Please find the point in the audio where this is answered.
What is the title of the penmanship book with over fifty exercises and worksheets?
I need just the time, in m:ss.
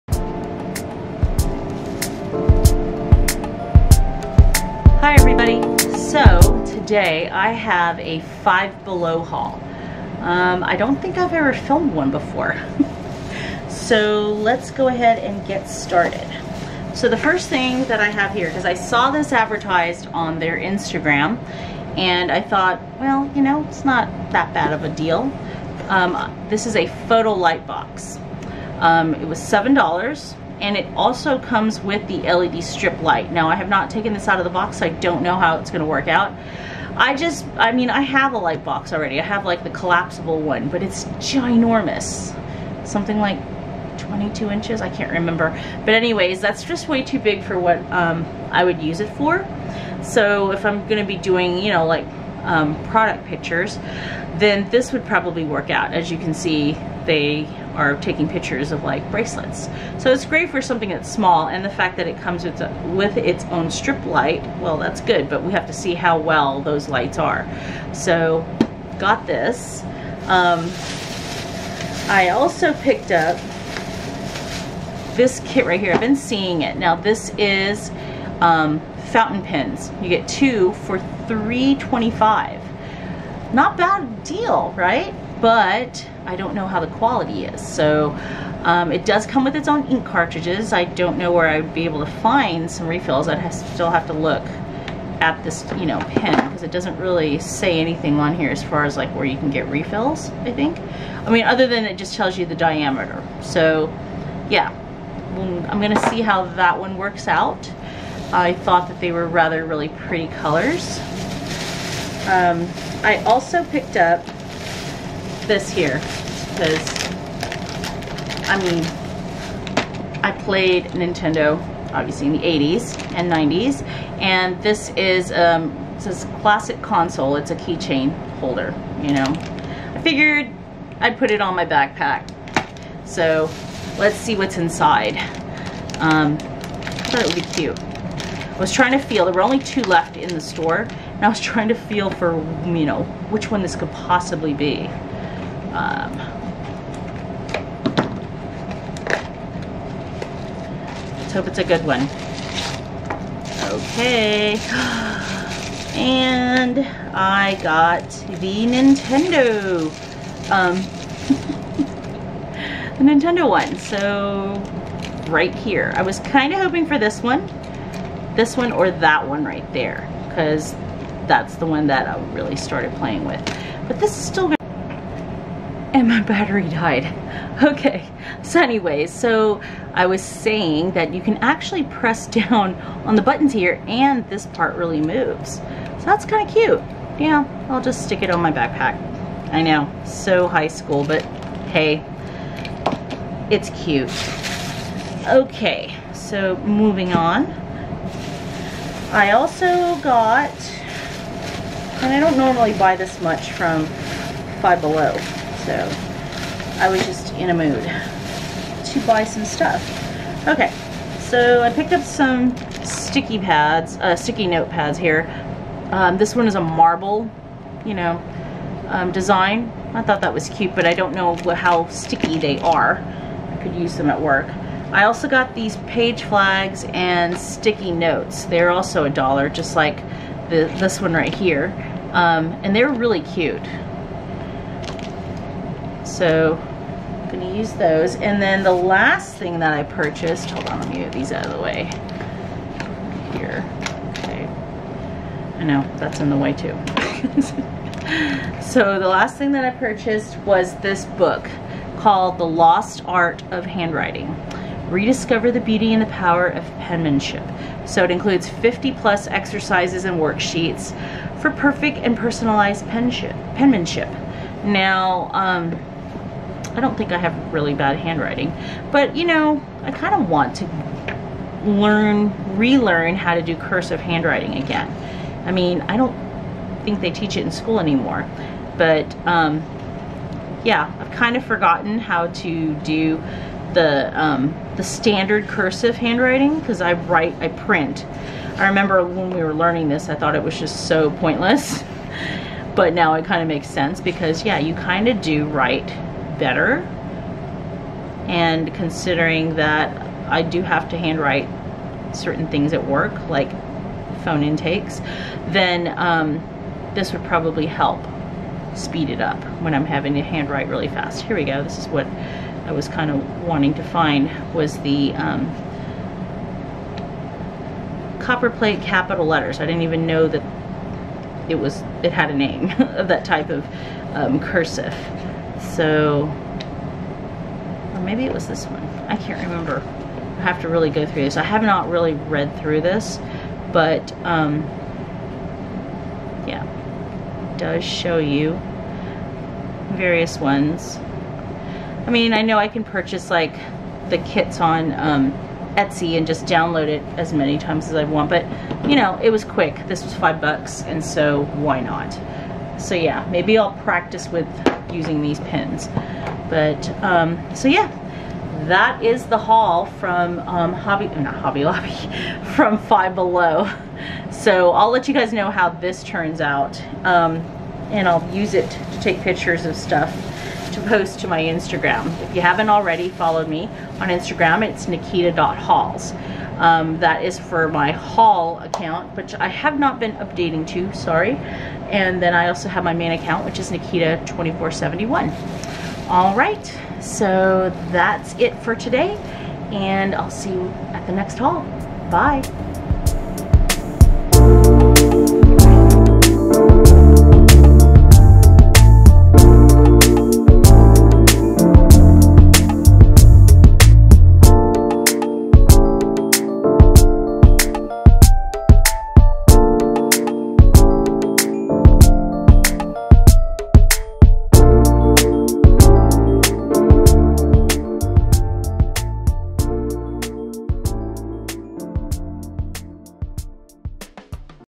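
4:12.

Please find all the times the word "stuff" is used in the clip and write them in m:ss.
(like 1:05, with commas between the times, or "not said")
3:29, 6:09.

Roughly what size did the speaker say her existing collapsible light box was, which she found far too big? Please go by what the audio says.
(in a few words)
22 inches.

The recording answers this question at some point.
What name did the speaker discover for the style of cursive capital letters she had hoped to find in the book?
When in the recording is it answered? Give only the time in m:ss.
5:18.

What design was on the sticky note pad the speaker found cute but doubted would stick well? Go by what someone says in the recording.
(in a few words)
marble.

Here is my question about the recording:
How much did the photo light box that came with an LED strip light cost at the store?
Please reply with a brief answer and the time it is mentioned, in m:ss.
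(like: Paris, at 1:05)
$7, at 0:29.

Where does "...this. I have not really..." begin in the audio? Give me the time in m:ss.
5:31.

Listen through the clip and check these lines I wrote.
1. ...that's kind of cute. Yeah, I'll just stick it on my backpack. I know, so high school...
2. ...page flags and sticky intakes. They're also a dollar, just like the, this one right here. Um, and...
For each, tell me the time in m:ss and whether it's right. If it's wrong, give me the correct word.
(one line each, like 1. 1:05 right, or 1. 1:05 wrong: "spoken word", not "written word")
1. 3:06 right
2. 3:45 wrong: "notes", not "intakes".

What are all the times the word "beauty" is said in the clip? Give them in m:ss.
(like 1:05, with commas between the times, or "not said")
4:15.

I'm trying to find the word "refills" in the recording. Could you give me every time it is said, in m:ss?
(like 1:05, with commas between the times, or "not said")
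1:32, 1:39.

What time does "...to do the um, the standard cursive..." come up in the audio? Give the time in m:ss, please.
4:42.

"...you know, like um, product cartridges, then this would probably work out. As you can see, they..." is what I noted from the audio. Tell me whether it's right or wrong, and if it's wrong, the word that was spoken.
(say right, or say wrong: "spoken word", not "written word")
wrong: "pictures", not "cartridges".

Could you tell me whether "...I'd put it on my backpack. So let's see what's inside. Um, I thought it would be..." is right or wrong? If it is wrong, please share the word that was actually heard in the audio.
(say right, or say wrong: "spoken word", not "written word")
right.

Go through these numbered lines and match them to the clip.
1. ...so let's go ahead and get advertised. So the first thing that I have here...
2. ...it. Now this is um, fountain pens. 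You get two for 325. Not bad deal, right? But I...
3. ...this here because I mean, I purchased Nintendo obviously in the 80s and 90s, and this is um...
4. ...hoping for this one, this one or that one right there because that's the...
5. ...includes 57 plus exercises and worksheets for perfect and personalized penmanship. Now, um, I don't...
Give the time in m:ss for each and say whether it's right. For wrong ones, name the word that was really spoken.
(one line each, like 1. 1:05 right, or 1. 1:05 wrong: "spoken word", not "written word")
1. 0:13 wrong: "started", not "advertised"
2. 1:16 right
3. 1:55 wrong: "played", not "purchased"
4. 2:46 right
5. 4:18 wrong: "50", not "57".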